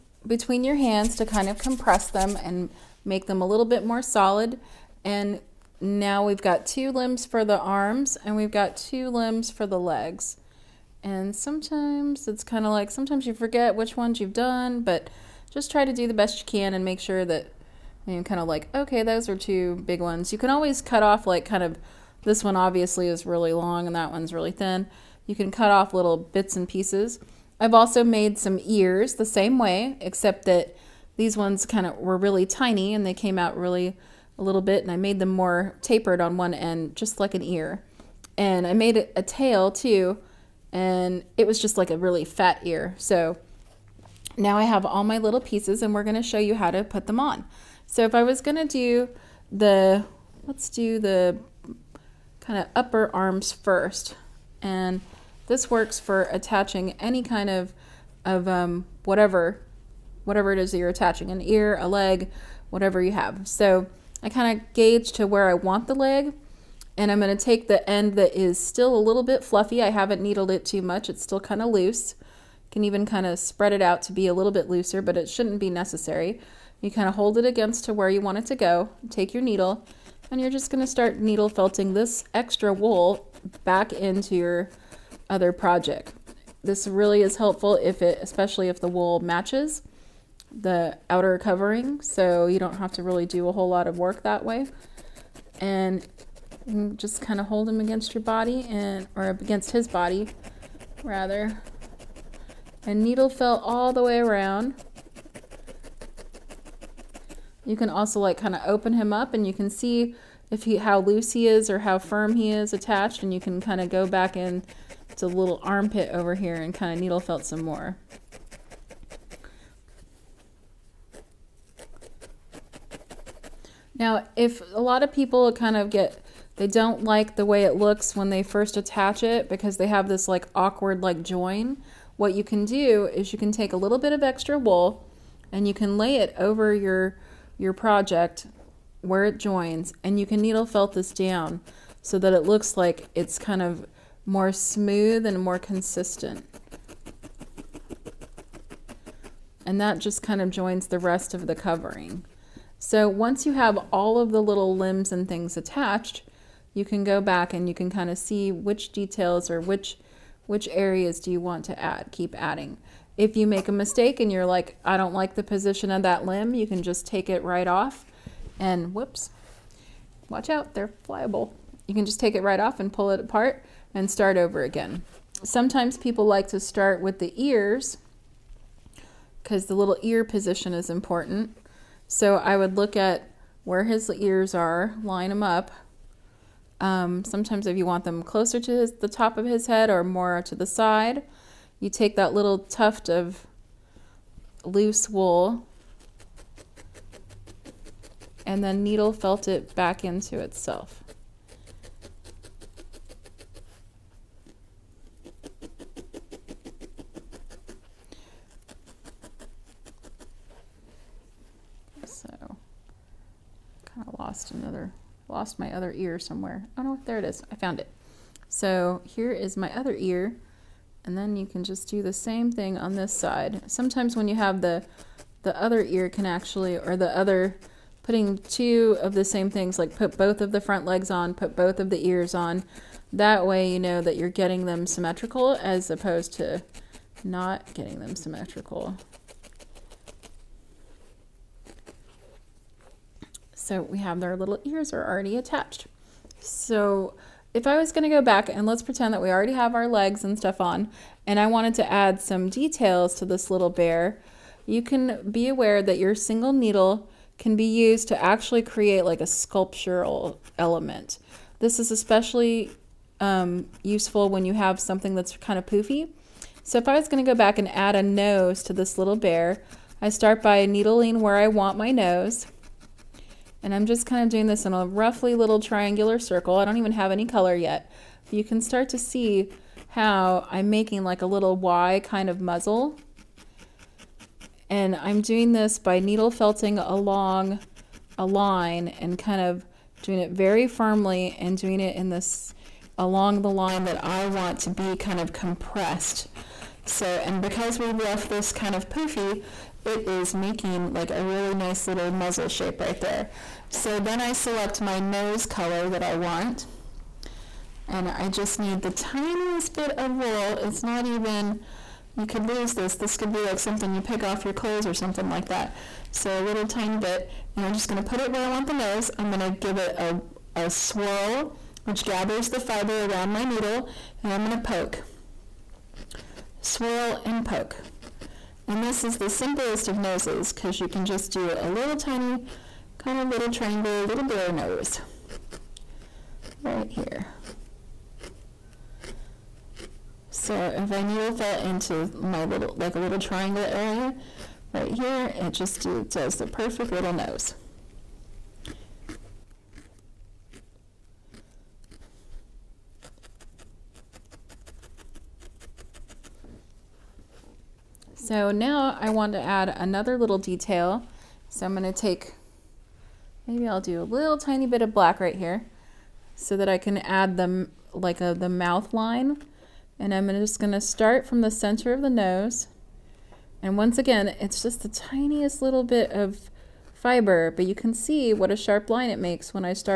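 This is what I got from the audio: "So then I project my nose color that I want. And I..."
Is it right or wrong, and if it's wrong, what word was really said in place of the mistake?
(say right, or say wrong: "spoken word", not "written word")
wrong: "select", not "project".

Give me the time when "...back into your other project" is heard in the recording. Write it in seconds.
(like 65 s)
83 s.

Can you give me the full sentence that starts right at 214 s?
lost another, lost my other ear somewhere.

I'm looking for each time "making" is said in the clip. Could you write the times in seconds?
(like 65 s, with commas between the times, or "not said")
280 s, 300 s.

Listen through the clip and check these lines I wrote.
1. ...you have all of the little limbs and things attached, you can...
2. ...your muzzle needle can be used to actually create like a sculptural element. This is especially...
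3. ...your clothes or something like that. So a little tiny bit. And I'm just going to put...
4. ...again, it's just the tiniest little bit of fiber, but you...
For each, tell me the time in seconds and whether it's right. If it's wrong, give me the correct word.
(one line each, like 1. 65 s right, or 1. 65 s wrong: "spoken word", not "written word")
1. 153 s right
2. 255 s wrong: "single", not "muzzle"
3. 314 s right
4. 373 s right.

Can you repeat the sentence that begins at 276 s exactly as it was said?
I don't even have any color yet.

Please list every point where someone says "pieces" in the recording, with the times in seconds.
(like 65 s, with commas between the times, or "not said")
26 s, 45 s.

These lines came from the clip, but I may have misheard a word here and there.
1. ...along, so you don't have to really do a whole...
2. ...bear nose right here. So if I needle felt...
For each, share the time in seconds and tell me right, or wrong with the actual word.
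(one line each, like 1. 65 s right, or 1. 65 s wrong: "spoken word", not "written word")
1. 91 s wrong: "covering", not "along"
2. 334 s right.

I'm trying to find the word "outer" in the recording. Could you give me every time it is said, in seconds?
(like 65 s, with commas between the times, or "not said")
91 s.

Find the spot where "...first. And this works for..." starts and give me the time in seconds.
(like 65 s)
53 s.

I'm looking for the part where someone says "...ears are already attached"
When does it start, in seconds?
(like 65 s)
244 s.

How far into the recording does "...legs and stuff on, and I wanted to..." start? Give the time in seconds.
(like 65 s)
249 s.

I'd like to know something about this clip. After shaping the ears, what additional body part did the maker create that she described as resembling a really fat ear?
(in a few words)
A tail.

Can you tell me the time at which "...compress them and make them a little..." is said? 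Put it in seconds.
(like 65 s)
1 s.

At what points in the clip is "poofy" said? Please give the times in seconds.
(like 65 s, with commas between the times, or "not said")
265 s, 298 s.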